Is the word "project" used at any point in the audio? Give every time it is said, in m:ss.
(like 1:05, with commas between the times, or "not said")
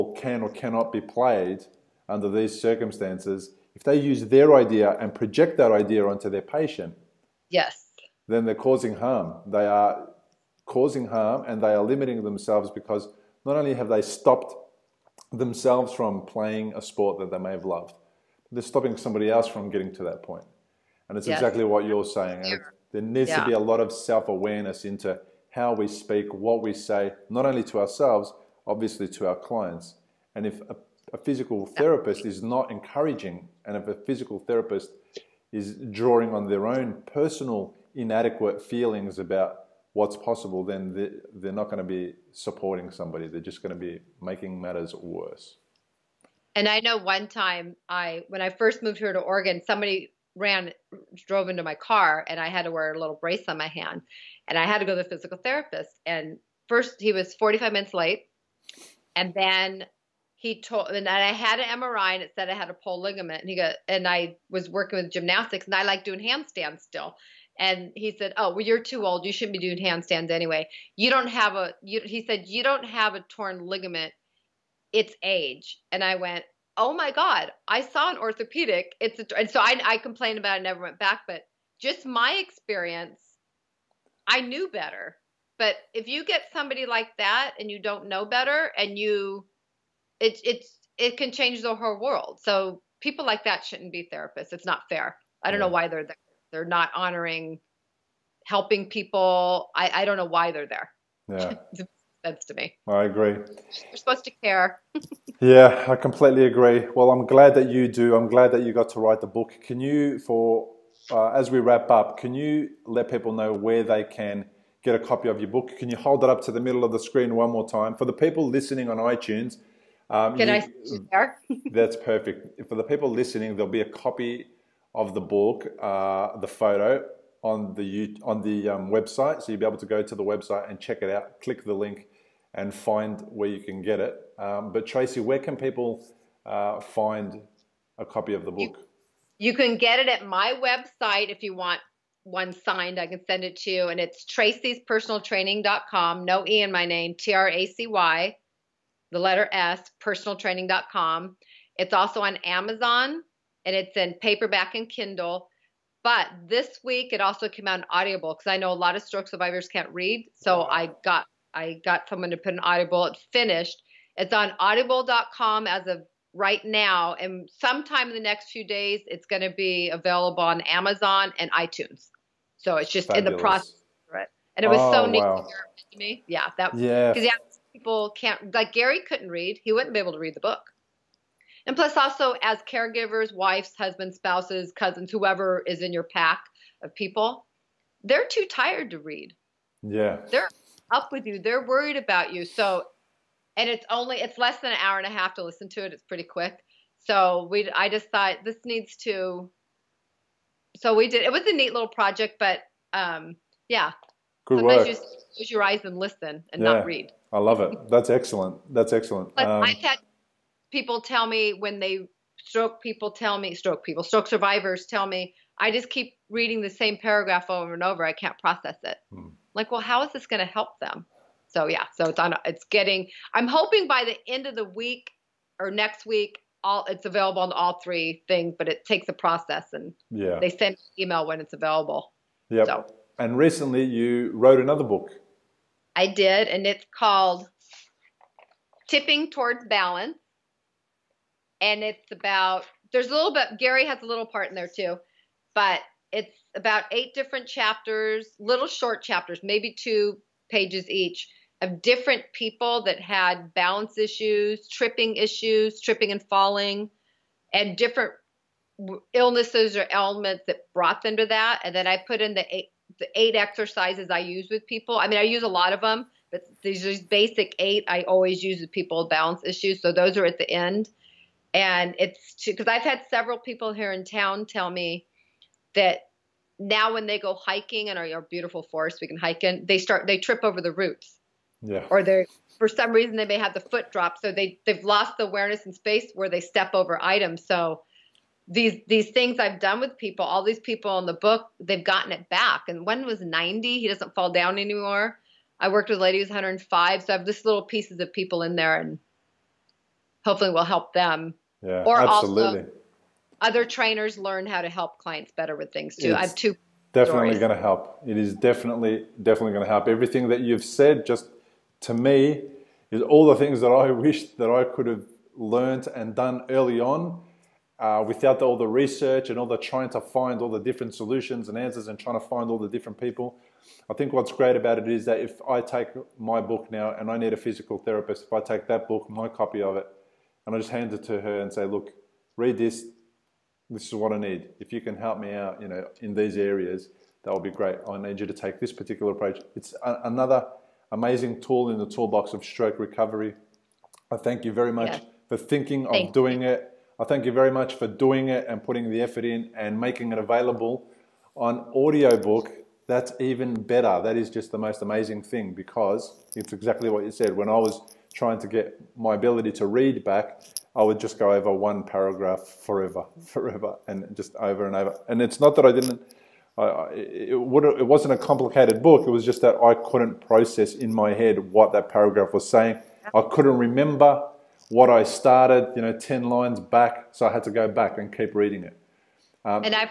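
0:05, 3:21.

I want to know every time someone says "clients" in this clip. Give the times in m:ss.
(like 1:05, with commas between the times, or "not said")
0:29, 5:04.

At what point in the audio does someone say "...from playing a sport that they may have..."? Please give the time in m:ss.
0:15.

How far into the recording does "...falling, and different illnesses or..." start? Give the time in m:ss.
4:16.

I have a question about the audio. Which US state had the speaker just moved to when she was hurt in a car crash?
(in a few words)
Oregon.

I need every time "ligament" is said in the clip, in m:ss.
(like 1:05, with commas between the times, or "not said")
1:03, 1:13.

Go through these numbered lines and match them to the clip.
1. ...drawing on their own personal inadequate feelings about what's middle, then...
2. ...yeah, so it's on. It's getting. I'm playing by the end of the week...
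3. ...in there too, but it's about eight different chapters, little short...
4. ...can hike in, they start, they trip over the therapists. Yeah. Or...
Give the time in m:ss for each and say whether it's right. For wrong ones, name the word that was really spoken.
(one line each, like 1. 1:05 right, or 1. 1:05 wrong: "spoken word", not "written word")
1. 0:35 wrong: "possible", not "middle"
2. 3:41 wrong: "hoping", not "playing"
3. 4:04 right
4. 4:39 wrong: "roots", not "therapists".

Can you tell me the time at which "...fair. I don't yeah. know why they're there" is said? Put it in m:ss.
1:34.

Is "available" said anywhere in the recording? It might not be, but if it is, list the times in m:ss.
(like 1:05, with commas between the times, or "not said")
2:49, 3:47, 3:51, 5:50.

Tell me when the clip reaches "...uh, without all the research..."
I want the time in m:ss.
5:17.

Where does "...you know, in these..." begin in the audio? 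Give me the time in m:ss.
5:35.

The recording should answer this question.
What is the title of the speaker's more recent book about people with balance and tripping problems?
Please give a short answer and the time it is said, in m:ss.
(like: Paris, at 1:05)
Tipping Towards Balance, at 3:58.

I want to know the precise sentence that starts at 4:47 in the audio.
So these these things I've done with people, all these people in the book, they've gotten it back.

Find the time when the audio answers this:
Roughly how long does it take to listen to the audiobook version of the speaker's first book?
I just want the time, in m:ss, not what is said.
3:14.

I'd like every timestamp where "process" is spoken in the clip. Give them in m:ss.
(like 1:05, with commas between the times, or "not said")
2:53, 3:38, 3:49, 6:10.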